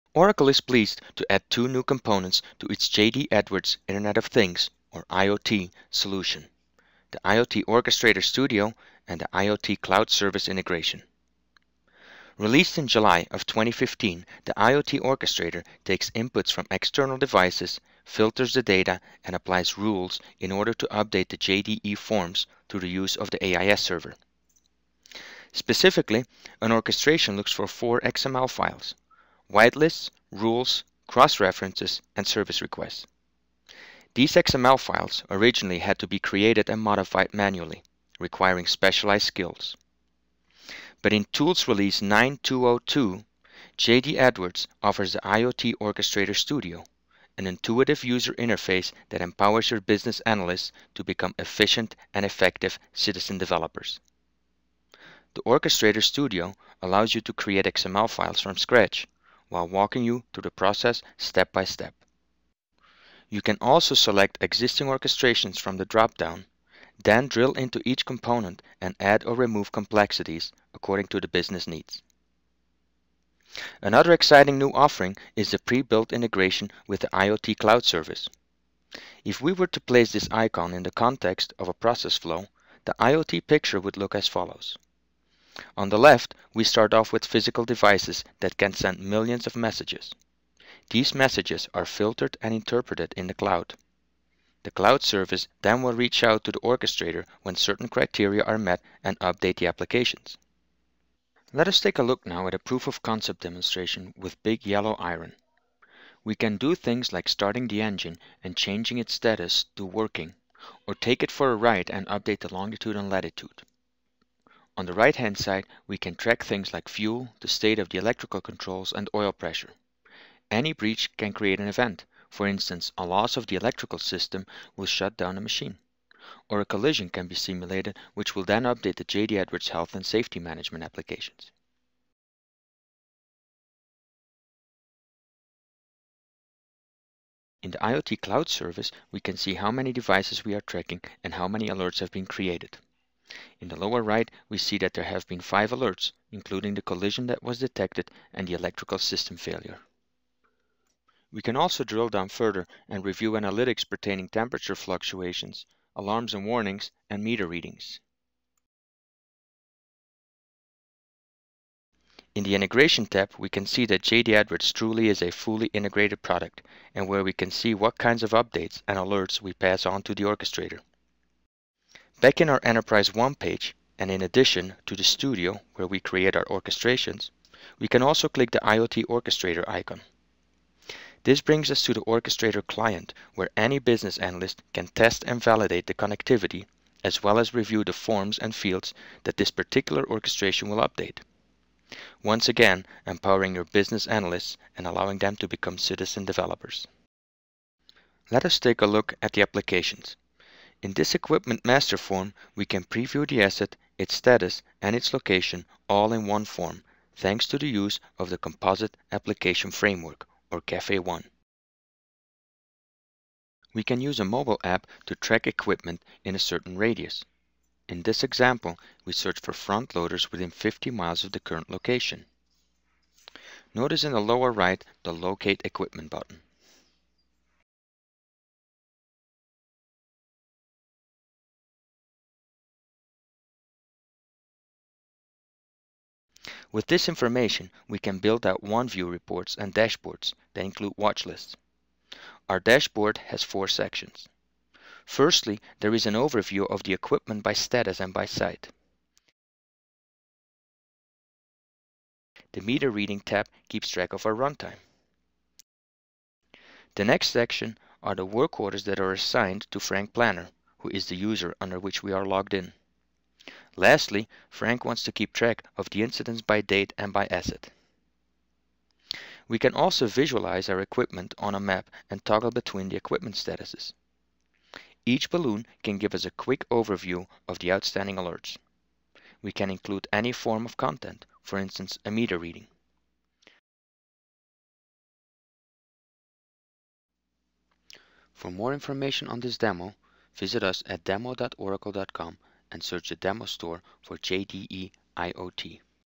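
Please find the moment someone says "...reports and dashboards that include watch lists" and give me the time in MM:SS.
03:59.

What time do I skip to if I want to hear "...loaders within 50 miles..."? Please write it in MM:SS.
03:39.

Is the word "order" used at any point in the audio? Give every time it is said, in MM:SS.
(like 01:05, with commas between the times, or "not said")
00:20, 04:18.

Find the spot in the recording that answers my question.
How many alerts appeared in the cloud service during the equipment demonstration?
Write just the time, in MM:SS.
02:25.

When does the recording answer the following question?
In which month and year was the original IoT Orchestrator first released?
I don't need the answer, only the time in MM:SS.
00:12.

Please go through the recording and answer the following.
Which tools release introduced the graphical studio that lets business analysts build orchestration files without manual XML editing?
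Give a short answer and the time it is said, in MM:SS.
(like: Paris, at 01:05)
Tools Release 9202, at 00:41.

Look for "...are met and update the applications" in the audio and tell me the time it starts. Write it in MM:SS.
01:38.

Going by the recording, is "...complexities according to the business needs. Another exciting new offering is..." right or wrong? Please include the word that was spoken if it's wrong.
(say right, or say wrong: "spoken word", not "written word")
right.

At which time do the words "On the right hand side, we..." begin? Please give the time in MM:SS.
01:54.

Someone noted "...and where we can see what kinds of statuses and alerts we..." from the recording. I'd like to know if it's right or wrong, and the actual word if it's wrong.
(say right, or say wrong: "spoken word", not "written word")
wrong: "updates", not "statuses".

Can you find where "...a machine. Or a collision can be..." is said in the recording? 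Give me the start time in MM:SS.
02:05.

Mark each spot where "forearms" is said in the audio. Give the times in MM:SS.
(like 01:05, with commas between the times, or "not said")
not said.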